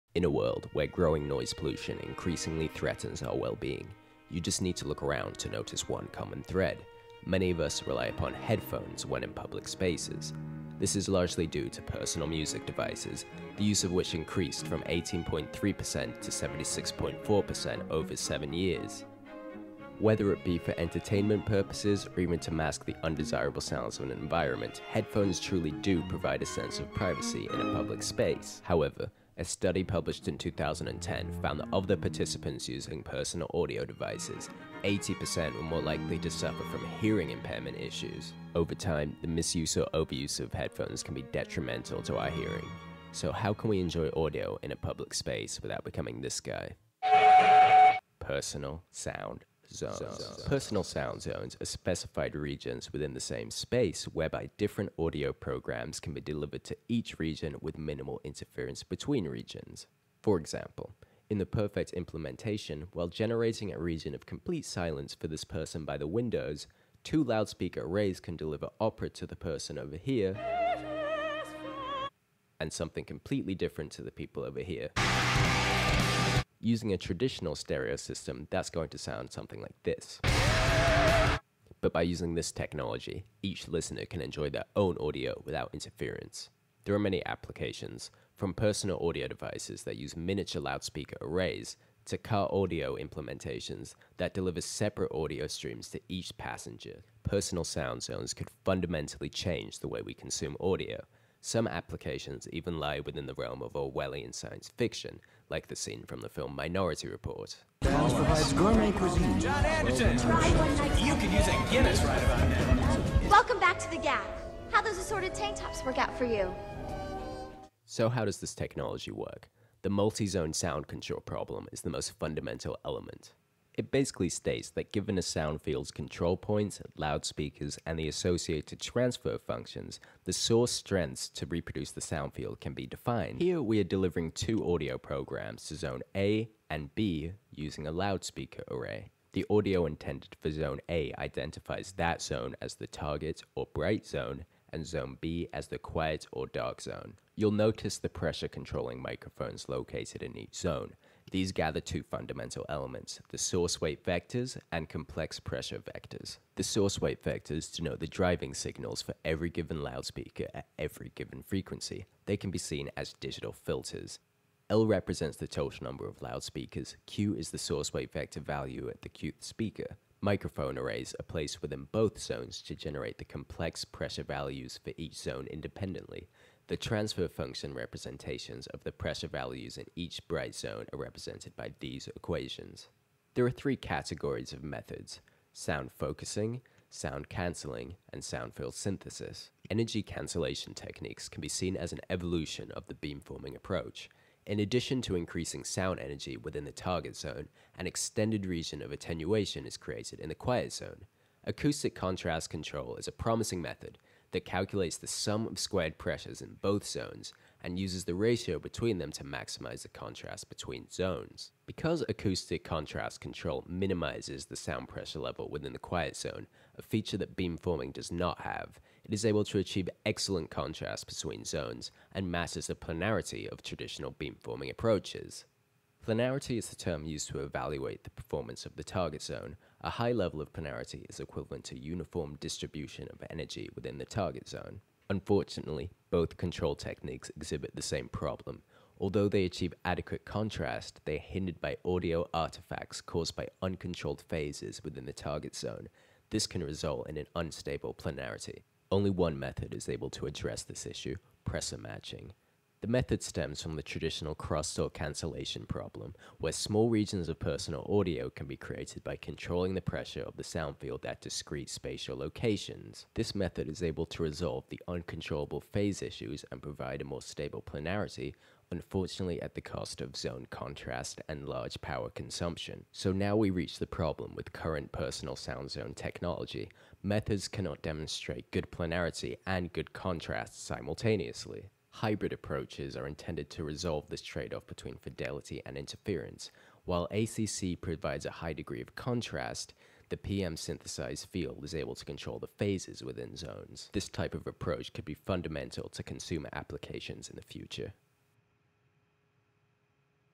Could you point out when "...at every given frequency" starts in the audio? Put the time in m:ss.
2:40.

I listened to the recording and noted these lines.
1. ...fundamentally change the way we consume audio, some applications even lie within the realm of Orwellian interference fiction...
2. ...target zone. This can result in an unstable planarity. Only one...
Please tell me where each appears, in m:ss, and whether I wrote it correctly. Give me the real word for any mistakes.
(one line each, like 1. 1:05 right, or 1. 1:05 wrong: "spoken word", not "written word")
1. 1:38 wrong: "science", not "interference"
2. 4:05 right.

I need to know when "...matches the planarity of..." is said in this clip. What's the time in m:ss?
3:42.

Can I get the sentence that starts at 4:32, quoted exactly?
So now we reach the problem with current personal sound zone technology.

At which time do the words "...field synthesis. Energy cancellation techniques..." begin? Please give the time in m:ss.
3:08.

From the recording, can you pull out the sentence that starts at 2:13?
Here we are delivering two audio programs to zone A and B using a loudspeaker array.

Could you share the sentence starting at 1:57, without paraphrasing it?
So how does this technology work?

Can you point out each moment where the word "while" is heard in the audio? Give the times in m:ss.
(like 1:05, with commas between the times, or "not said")
1:02, 4:46.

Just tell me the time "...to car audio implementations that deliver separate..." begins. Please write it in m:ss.
1:32.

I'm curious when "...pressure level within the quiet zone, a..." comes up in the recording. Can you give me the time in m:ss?
3:34.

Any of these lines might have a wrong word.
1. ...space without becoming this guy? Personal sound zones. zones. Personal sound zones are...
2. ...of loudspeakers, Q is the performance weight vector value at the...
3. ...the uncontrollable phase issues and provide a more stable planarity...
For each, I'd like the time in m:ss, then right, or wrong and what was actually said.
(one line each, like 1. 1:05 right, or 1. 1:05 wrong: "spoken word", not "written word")
1. 0:45 right
2. 2:46 wrong: "source", not "performance"
3. 4:24 right.